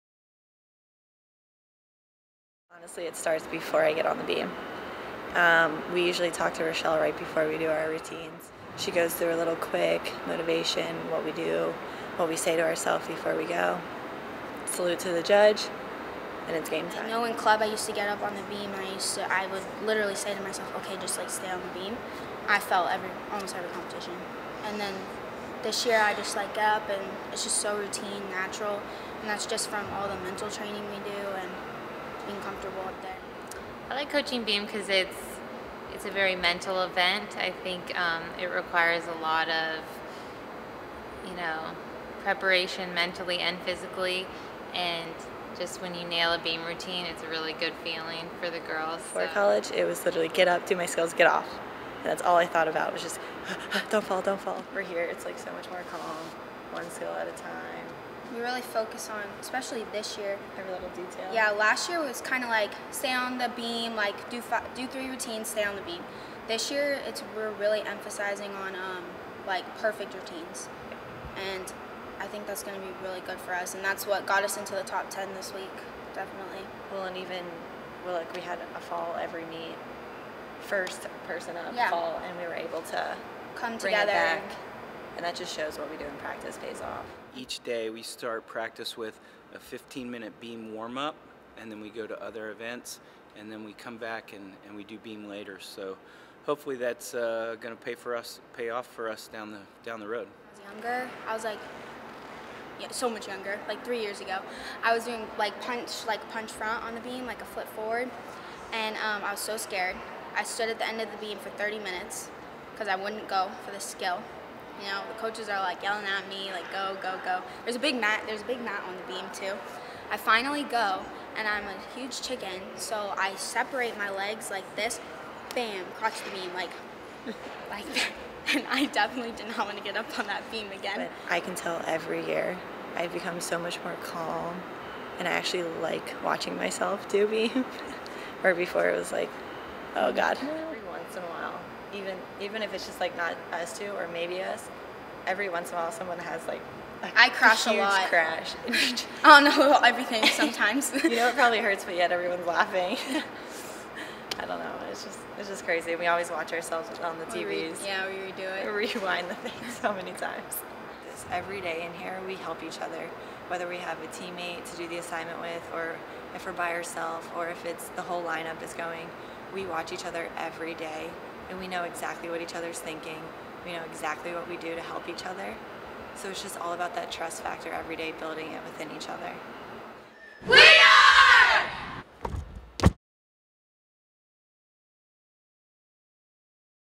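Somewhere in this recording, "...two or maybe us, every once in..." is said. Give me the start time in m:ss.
2:23.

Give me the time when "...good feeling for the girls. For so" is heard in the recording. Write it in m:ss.
0:47.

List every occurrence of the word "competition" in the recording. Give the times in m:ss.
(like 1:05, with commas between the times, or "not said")
0:23.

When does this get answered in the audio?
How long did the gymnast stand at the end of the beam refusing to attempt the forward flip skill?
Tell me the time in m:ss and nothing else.
1:51.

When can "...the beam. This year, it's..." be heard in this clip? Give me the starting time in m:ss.
1:05.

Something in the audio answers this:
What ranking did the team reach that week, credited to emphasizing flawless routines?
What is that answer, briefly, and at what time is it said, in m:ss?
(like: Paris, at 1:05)
top ten, at 1:14.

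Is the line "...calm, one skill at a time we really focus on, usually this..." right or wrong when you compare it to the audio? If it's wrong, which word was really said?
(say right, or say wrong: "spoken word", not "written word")
wrong: "especially", not "usually".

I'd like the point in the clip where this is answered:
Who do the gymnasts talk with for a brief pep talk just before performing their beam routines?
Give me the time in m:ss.
0:06.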